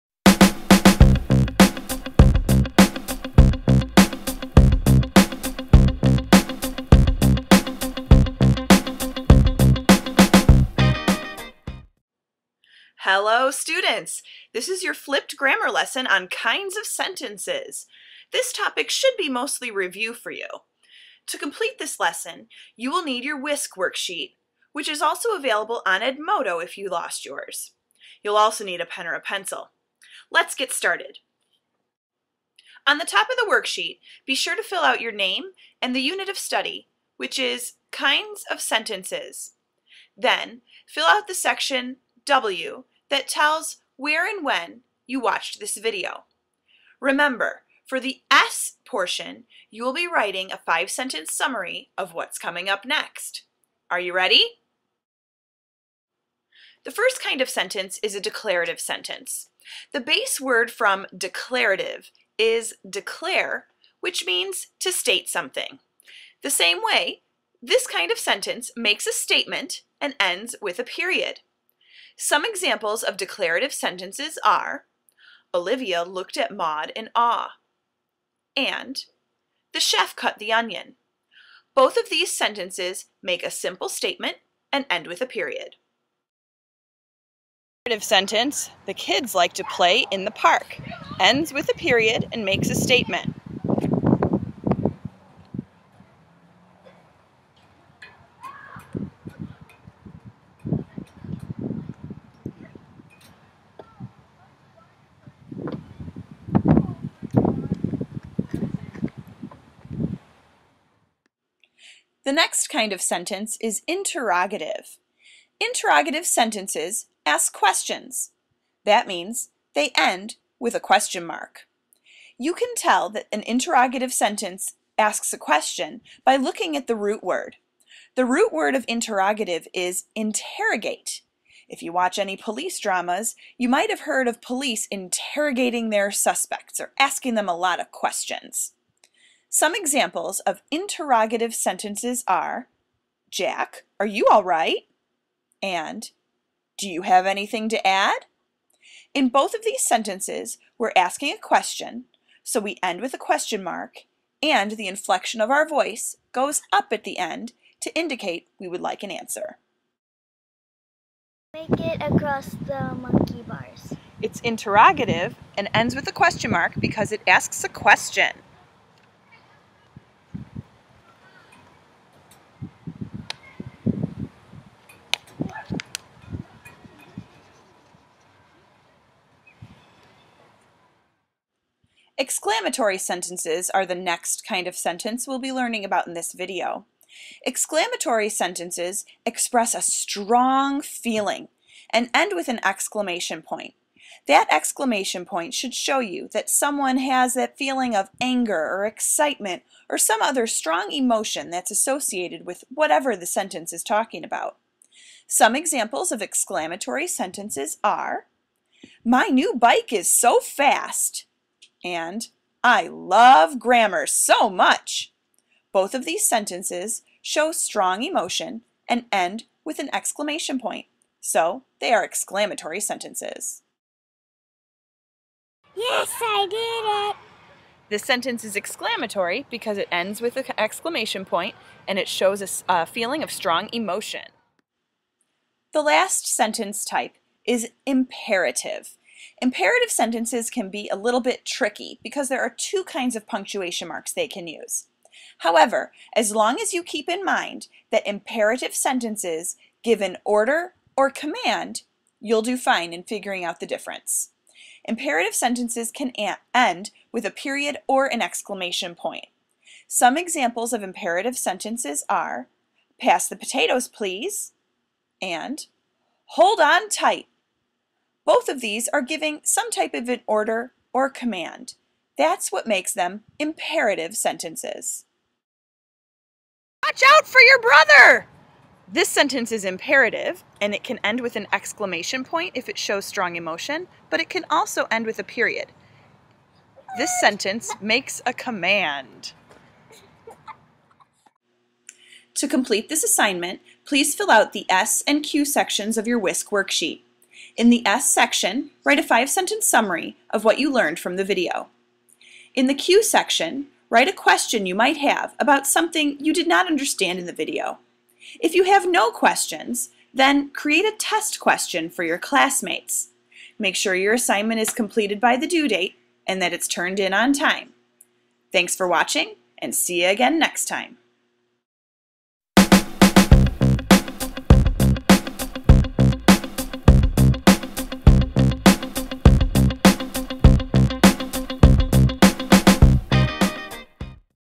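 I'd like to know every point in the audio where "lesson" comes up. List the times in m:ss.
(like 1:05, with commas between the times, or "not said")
0:15, 0:21.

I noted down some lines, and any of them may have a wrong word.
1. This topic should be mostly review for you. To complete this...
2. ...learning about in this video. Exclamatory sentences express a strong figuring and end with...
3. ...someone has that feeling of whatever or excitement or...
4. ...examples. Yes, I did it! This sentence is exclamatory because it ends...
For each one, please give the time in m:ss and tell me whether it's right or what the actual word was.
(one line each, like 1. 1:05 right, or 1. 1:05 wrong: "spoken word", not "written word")
1. 0:18 right
2. 3:05 wrong: "feeling", not "figuring"
3. 3:16 wrong: "anger", not "whatever"
4. 3:42 wrong: "sentences", not "examples".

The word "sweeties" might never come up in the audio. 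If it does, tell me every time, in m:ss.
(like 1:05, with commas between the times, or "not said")
not said.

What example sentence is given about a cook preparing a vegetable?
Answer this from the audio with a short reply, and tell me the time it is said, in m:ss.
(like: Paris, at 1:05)
The chef cut the onion, at 1:19.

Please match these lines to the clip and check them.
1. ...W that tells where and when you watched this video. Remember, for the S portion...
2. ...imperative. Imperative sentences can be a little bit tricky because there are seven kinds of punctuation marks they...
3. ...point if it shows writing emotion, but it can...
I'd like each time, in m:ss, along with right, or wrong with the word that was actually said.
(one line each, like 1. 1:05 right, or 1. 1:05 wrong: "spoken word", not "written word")
1. 0:42 right
2. 3:57 wrong: "two", not "seven"
3. 4:42 wrong: "strong", not "writing".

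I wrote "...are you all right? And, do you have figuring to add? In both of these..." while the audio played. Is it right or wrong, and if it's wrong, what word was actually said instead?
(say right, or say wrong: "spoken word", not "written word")
wrong: "anything", not "figuring".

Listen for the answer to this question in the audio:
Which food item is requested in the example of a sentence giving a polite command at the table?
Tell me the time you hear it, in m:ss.
4:23.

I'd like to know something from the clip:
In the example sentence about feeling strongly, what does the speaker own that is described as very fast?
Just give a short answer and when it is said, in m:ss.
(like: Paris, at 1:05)
New bike, at 3:29.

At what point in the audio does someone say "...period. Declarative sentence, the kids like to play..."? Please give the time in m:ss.
1:25.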